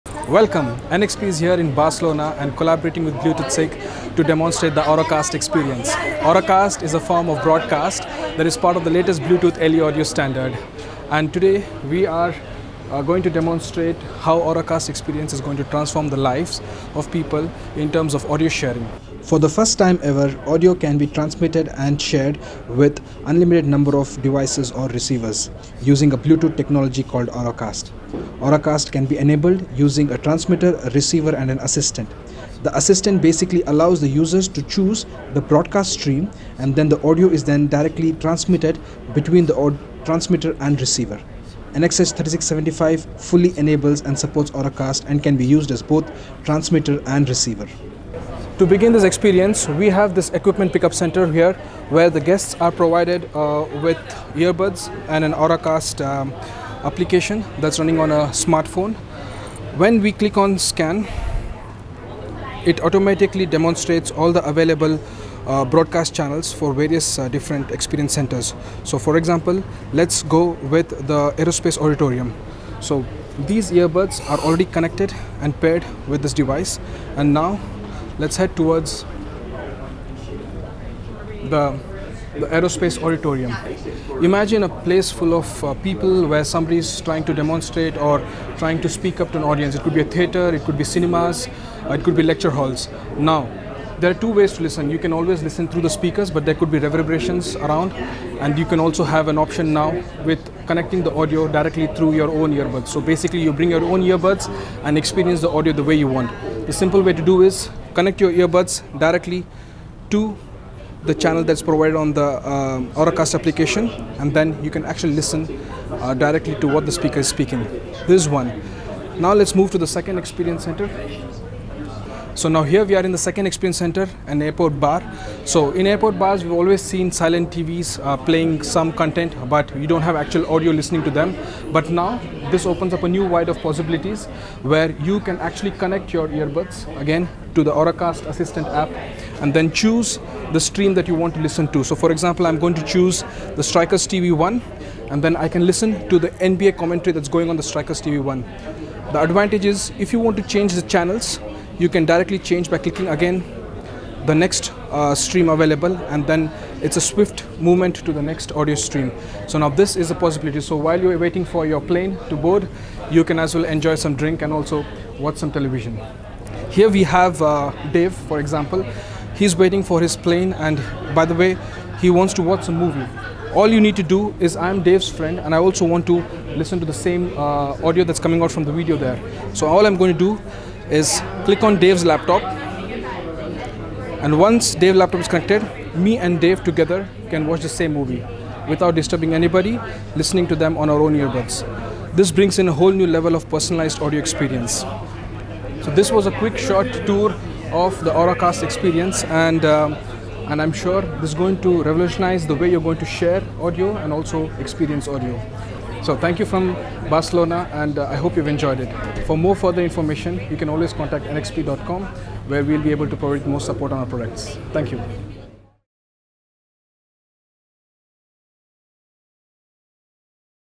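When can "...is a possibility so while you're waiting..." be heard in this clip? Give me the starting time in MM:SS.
02:39.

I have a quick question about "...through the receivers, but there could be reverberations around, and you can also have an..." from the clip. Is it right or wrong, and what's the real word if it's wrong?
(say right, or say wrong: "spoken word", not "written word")
wrong: "speakers", not "receivers".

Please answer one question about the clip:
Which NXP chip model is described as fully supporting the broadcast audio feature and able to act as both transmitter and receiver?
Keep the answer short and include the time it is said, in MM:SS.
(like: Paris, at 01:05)
NXH 3675, at 00:41.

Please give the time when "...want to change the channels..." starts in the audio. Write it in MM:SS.
02:30.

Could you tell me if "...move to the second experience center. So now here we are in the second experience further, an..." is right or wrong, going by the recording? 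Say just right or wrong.
wrong.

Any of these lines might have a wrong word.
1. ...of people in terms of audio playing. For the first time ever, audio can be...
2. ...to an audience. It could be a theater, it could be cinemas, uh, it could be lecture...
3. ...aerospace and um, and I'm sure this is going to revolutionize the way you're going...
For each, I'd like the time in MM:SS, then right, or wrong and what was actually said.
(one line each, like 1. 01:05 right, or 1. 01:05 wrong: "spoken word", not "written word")
1. 00:16 wrong: "sharing", not "playing"
2. 01:29 right
3. 03:18 wrong: "experience", not "aerospace".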